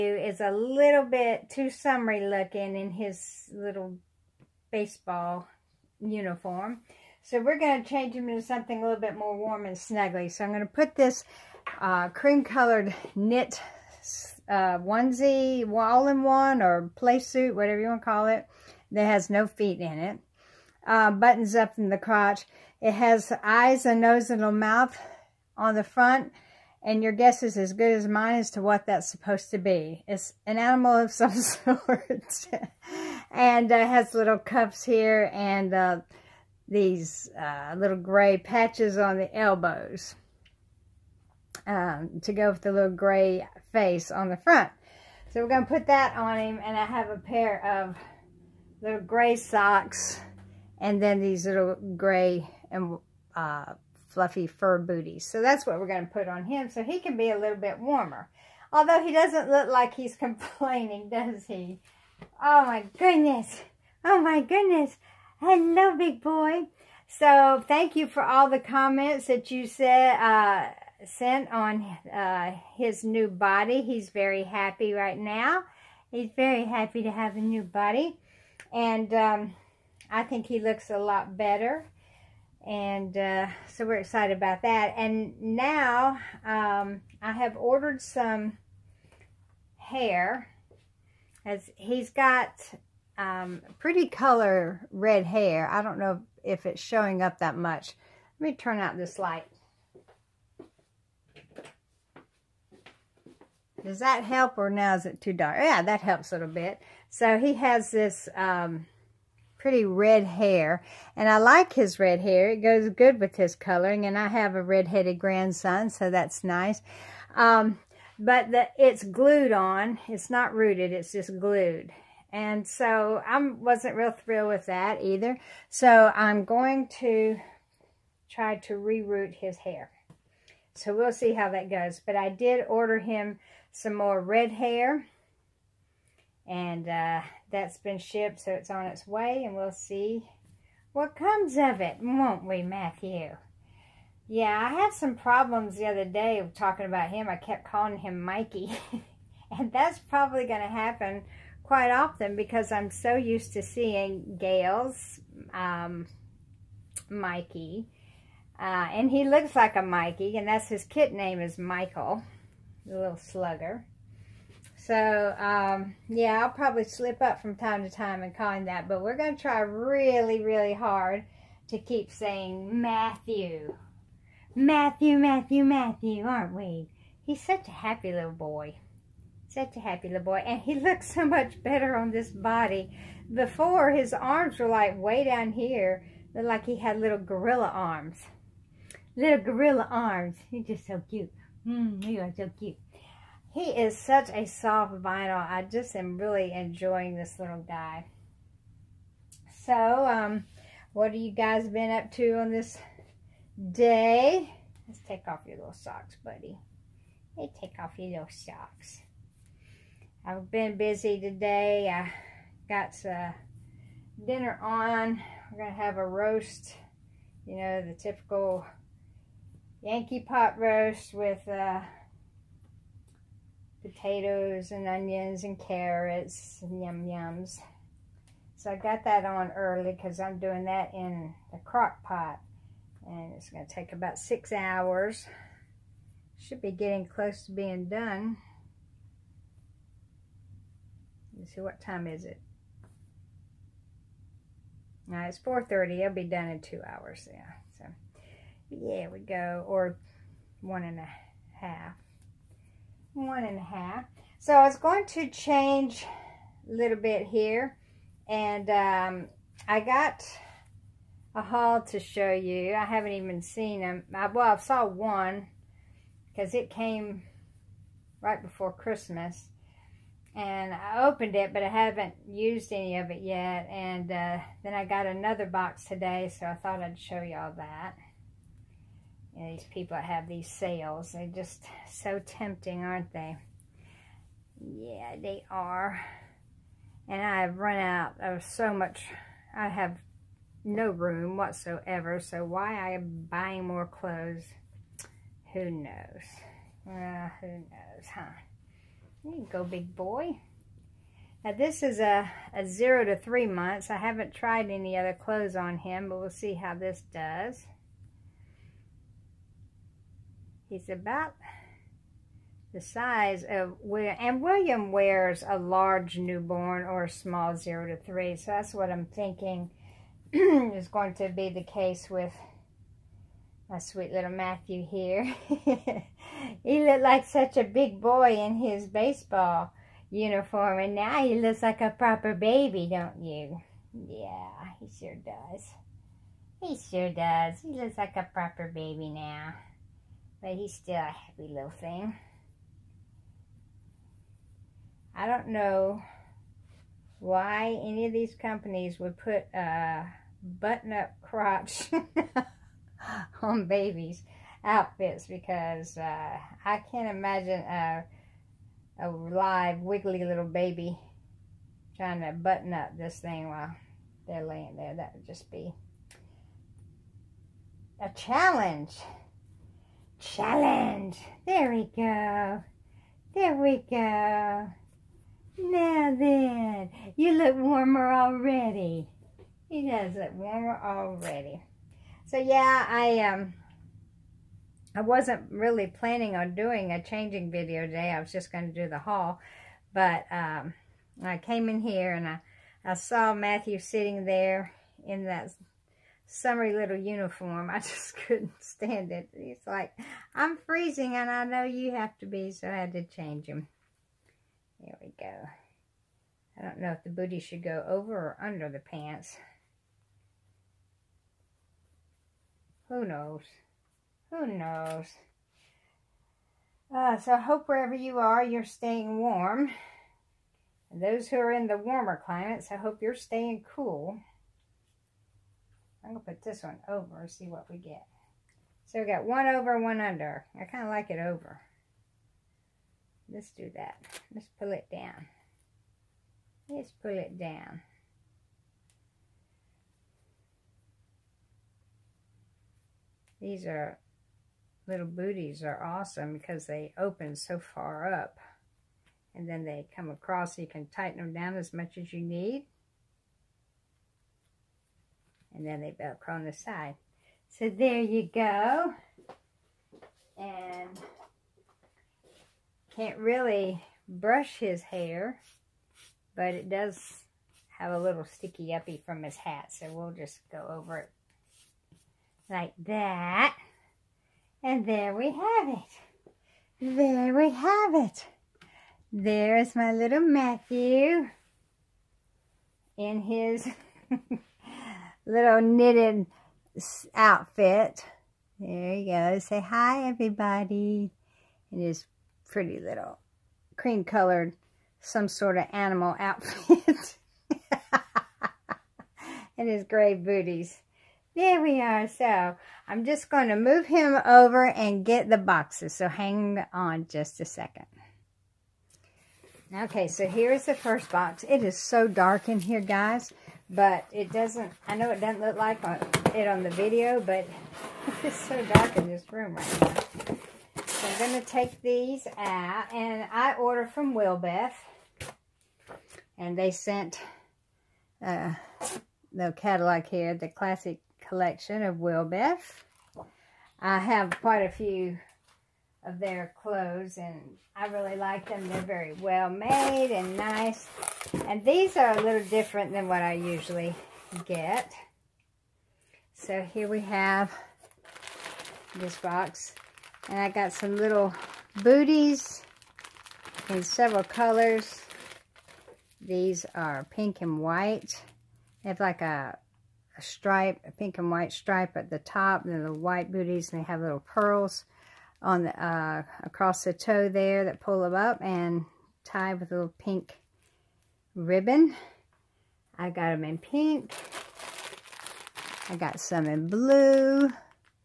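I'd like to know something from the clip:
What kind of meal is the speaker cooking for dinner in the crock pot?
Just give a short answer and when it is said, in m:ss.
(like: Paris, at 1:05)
pot roast, at 3:39.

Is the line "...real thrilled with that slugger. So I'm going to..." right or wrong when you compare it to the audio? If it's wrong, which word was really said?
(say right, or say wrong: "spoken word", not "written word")
wrong: "either", not "slugger".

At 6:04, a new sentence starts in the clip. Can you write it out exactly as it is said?
That would just be a challenge.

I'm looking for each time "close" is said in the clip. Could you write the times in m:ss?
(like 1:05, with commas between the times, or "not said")
3:57.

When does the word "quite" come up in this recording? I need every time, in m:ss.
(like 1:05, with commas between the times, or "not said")
2:31, 8:54.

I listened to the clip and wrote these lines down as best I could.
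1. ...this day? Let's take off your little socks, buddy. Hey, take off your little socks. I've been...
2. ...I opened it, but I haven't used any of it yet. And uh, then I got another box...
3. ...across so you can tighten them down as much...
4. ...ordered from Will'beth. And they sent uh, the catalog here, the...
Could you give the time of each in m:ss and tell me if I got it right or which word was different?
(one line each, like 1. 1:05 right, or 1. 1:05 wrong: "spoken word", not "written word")
1. 3:22 right
2. 4:30 right
3. 7:30 right
4. 8:43 right.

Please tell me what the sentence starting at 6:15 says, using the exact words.
Now then, you look warmer already.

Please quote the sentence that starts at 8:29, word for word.
Okay, so here's the first box.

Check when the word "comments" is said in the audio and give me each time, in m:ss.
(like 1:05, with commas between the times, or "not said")
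1:08.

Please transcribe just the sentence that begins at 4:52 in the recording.
So why I am buying more clothes, who knows?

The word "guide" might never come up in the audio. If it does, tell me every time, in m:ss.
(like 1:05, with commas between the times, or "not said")
not said.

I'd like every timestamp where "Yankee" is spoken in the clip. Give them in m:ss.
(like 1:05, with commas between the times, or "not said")
3:39.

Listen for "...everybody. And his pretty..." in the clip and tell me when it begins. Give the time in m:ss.
8:10.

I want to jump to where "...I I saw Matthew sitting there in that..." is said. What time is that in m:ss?
6:32.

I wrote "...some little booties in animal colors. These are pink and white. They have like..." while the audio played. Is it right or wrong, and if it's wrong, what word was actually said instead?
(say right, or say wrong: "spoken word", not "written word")
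wrong: "several", not "animal".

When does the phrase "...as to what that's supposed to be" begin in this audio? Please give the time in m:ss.
0:28.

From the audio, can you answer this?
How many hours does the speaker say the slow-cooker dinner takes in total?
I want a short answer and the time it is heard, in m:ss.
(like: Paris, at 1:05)
6, at 3:53.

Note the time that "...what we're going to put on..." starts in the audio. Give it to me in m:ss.
0:55.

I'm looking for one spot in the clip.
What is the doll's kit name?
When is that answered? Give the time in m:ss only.
2:41.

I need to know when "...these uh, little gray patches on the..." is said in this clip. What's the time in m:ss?
0:36.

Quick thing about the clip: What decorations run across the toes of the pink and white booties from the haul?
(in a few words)
little pearls.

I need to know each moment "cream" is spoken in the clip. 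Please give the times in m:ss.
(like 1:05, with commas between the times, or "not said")
0:12, 8:13.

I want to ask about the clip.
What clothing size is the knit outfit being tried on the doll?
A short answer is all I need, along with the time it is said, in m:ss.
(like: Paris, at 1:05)
0 to 3 months, at 5:02.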